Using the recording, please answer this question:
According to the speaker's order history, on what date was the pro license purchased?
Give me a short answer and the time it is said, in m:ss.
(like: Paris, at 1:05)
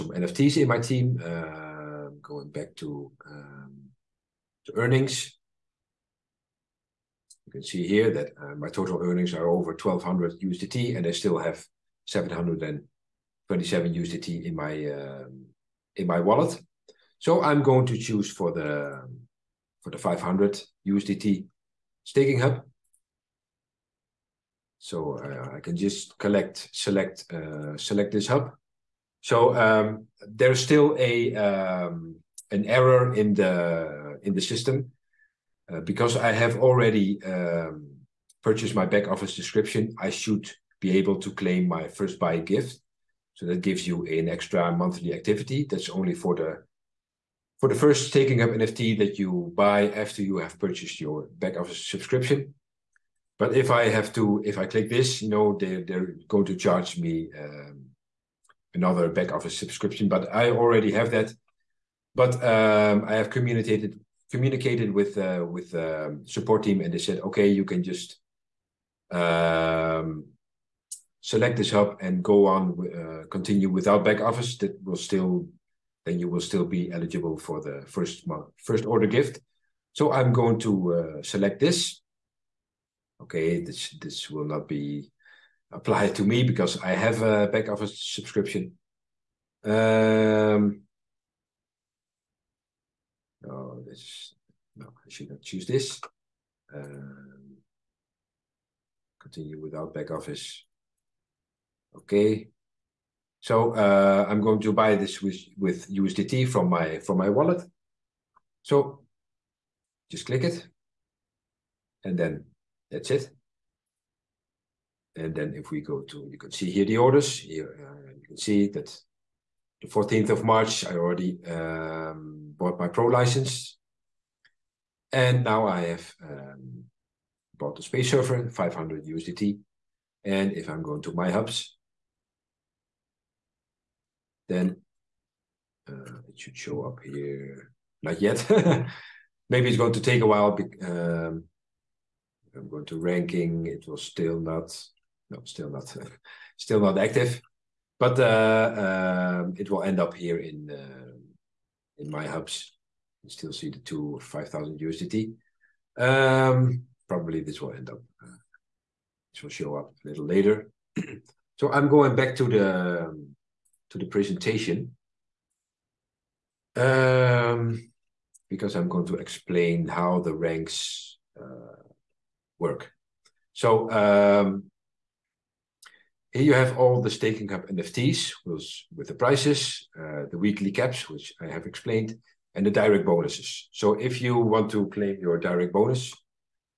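14th of March, at 1:59.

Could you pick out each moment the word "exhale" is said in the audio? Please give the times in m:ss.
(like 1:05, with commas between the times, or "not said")
not said.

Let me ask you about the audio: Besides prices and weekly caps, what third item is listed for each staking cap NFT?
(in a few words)
direct bonuses.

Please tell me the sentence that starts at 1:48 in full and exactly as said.
So just click it, and then that's it.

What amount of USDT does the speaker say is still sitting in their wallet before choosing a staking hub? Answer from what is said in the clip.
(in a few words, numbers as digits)
727 USDT.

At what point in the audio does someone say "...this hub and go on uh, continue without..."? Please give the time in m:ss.
1:11.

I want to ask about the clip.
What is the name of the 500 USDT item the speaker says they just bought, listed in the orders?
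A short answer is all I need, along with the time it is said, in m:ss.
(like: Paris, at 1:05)
space server, at 2:07.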